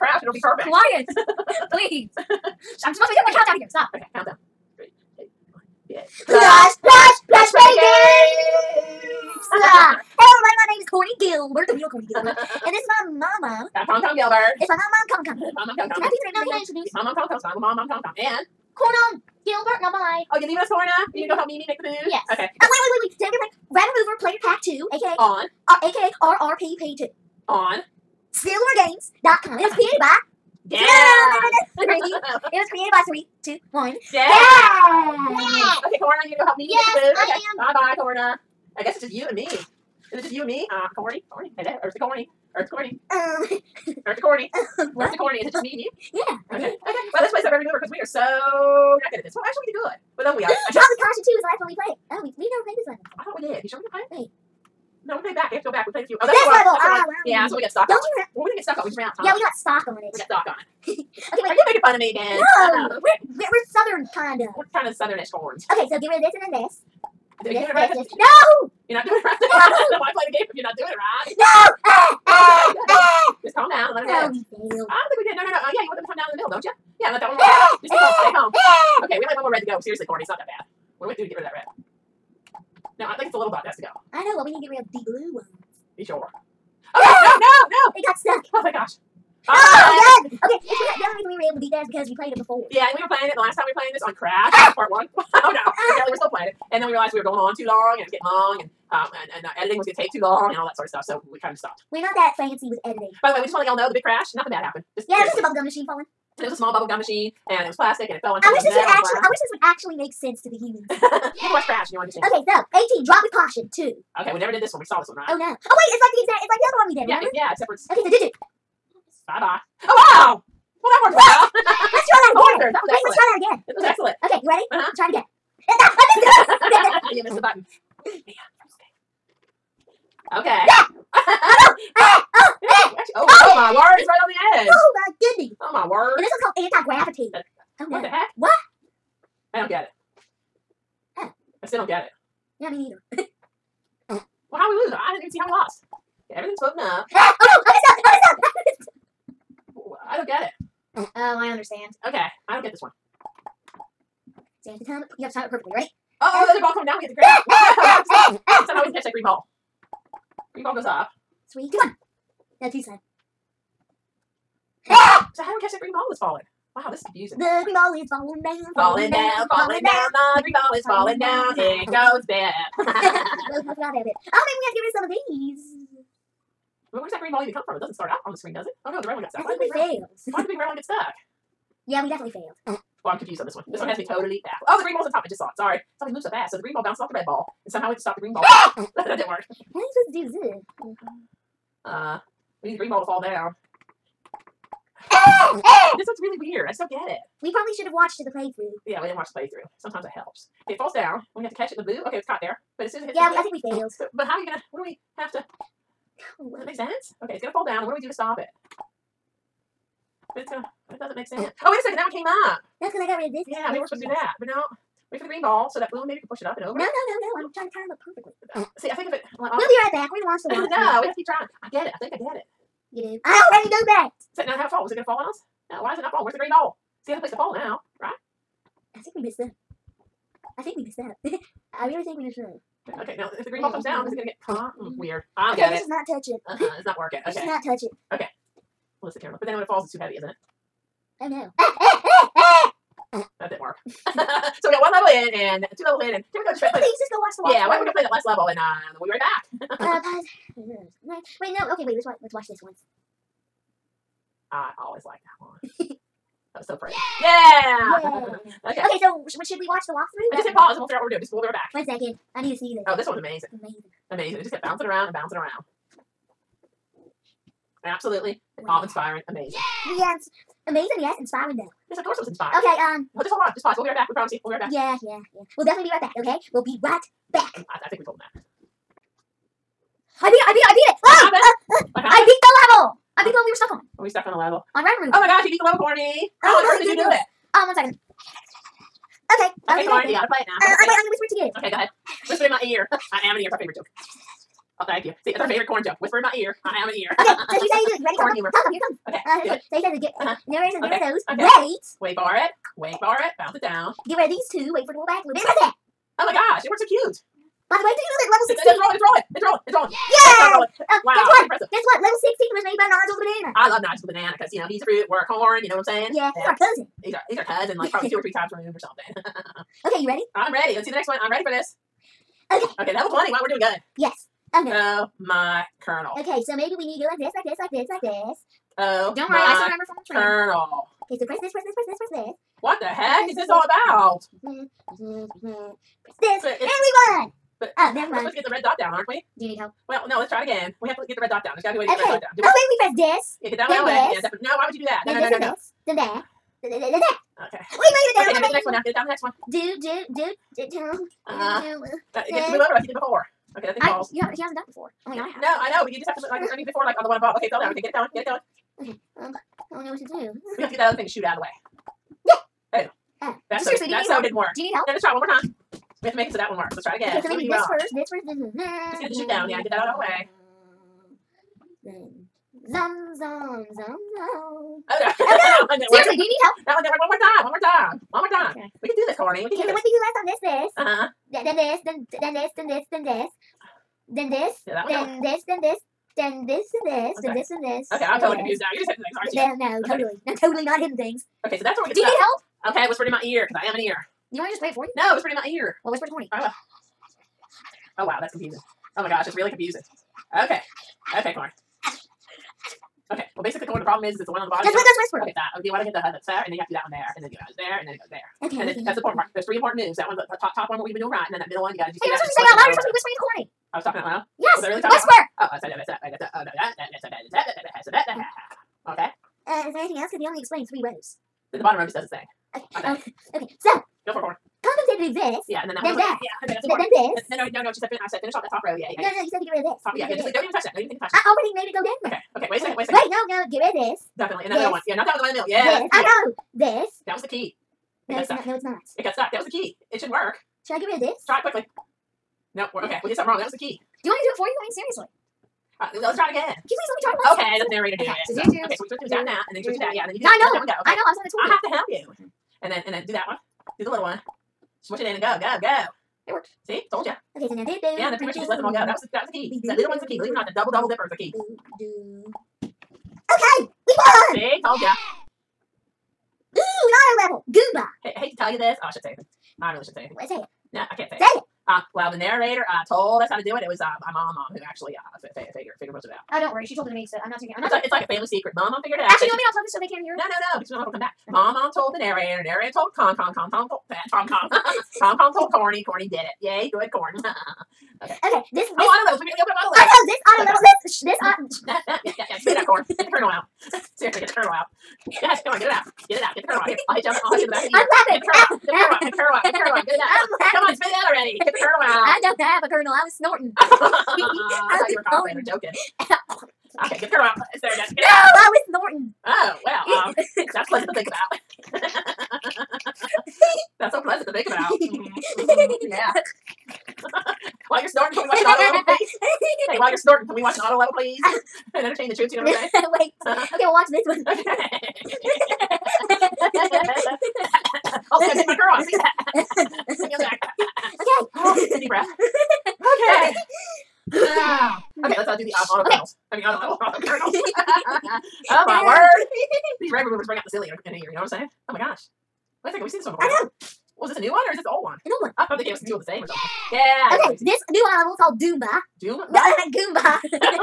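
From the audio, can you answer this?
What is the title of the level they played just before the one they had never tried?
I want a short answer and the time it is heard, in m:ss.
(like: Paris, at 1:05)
Drop with Caution 2, at 0:50.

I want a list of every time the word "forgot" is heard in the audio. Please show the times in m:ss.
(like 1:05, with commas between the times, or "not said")
2:53.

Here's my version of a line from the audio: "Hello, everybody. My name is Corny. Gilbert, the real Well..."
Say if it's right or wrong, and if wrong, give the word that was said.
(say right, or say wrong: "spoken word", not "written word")
wrong: "Corny", not "Well".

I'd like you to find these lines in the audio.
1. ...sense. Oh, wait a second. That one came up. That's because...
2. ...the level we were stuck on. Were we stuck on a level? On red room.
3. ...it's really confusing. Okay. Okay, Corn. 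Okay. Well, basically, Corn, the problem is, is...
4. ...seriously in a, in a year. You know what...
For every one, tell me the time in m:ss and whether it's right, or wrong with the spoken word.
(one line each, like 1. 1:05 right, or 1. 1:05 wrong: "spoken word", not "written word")
1. 3:31 right
2. 4:43 right
3. 6:39 right
4. 9:00 wrong: "silly", not "seriously".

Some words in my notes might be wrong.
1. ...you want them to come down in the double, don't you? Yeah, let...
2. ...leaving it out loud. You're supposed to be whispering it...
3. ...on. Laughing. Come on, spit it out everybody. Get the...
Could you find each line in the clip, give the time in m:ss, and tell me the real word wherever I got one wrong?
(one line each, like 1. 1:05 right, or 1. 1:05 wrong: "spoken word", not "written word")
1. 1:15 wrong: "middle", not "double"
2. 6:52 wrong: "saying", not "leaving"
3. 8:20 wrong: "already", not "everybody".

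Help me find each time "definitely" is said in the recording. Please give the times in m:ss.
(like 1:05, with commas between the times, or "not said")
3:02, 4:35, 5:44, 7:14.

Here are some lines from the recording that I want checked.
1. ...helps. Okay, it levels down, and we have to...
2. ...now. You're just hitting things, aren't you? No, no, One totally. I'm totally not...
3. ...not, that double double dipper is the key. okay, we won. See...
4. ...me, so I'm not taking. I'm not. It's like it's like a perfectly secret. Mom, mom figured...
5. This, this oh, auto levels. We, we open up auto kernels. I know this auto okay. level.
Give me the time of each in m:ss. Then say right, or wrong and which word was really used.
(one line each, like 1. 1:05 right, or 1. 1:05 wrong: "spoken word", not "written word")
1. 3:20 wrong: "falls", not "levels"
2. 6:28 right
3. 7:40 right
4. 7:56 wrong: "family", not "perfectly"
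5. 8:08 wrong: "levels", not "kernels".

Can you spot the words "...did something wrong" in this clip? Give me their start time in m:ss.
7:23.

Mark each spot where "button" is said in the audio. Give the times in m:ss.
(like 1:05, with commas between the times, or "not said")
2:07.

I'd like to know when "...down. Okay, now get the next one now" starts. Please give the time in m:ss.
5:48.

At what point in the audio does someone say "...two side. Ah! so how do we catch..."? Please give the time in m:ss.
2:42.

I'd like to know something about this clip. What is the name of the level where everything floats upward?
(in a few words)
Anti gravity.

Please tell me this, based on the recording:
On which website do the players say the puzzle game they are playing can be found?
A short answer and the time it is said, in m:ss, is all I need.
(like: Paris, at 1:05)
silvergames.com, at 0:28.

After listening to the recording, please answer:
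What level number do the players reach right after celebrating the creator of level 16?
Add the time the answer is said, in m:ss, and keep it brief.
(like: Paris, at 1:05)
20, at 5:22.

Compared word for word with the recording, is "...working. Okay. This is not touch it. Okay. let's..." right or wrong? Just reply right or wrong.
right.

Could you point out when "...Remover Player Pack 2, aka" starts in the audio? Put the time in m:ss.
0:23.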